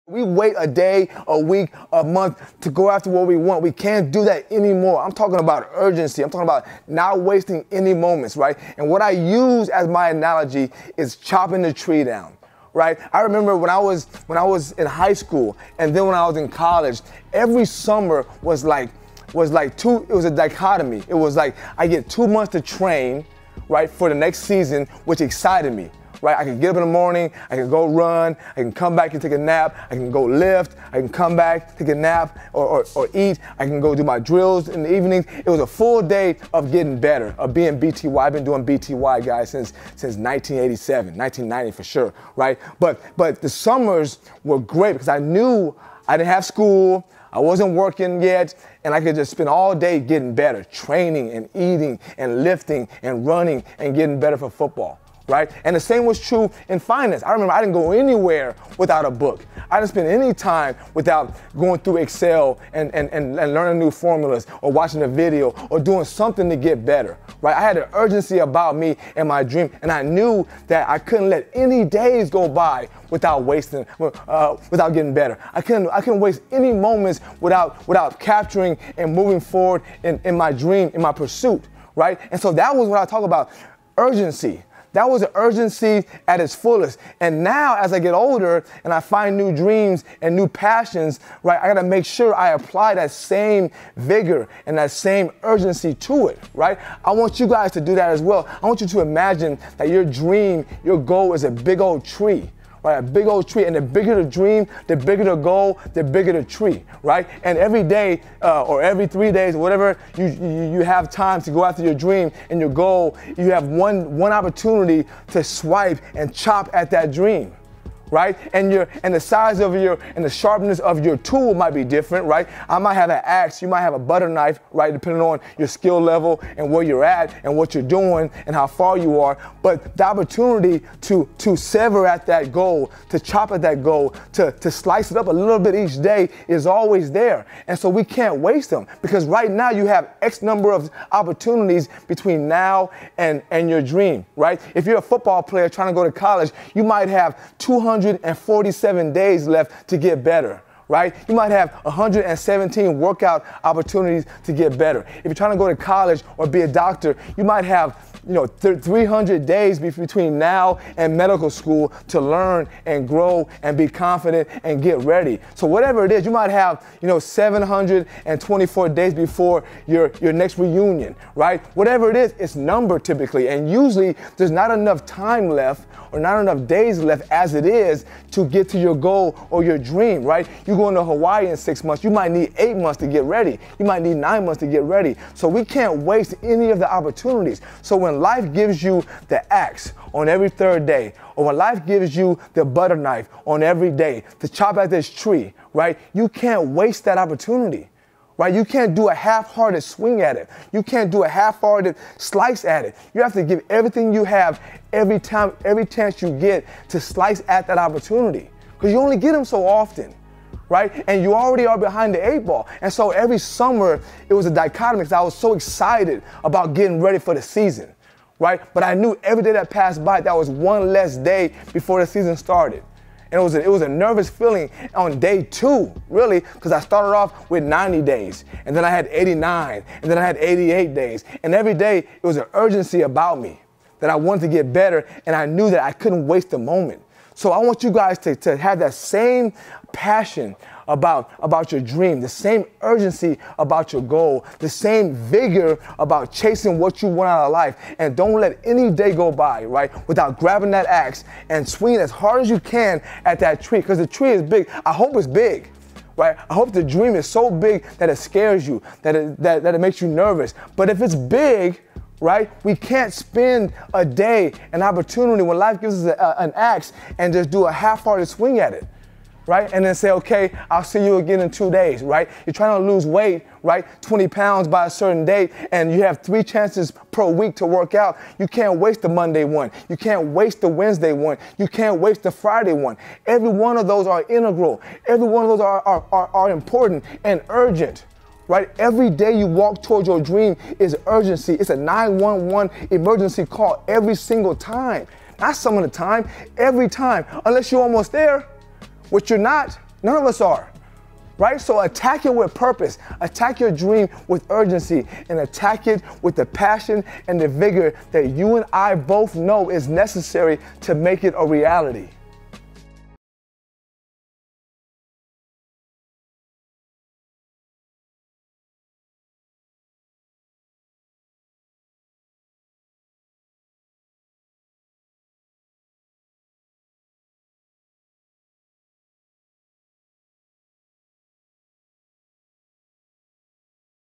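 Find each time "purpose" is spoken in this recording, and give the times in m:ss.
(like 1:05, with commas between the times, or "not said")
5:02.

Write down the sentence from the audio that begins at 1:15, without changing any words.
I couldn't, I couldn't waste any moments without, without capturing and moving forward in, in my dream, in my pursuit, right?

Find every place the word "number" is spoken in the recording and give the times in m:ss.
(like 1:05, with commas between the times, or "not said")
2:20, 2:52.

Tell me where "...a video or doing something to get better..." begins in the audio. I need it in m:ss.
1:05.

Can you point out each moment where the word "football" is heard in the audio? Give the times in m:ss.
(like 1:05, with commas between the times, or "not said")
0:54, 2:25.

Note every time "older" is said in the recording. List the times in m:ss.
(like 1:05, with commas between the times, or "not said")
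1:28.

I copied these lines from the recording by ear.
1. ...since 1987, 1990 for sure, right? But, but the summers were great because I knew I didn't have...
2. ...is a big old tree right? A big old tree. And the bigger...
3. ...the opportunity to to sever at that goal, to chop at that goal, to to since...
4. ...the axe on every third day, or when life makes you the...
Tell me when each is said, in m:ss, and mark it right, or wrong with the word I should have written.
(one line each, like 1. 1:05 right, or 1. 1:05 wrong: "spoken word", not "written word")
1. 0:39 right
2. 1:41 right
3. 2:09 wrong: "slice", not "since"
4. 3:09 wrong: "gives", not "makes".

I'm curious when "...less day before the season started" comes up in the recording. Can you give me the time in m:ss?
3:40.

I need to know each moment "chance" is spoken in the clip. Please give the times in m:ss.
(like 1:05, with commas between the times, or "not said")
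3:25, 4:36.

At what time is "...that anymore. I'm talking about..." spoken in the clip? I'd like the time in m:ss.
0:04.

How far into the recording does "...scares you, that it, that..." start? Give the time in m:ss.
4:18.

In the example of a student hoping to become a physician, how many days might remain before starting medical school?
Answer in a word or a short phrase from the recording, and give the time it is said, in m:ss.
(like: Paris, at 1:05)
300, at 2:38.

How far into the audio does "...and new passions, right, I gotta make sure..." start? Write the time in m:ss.
1:30.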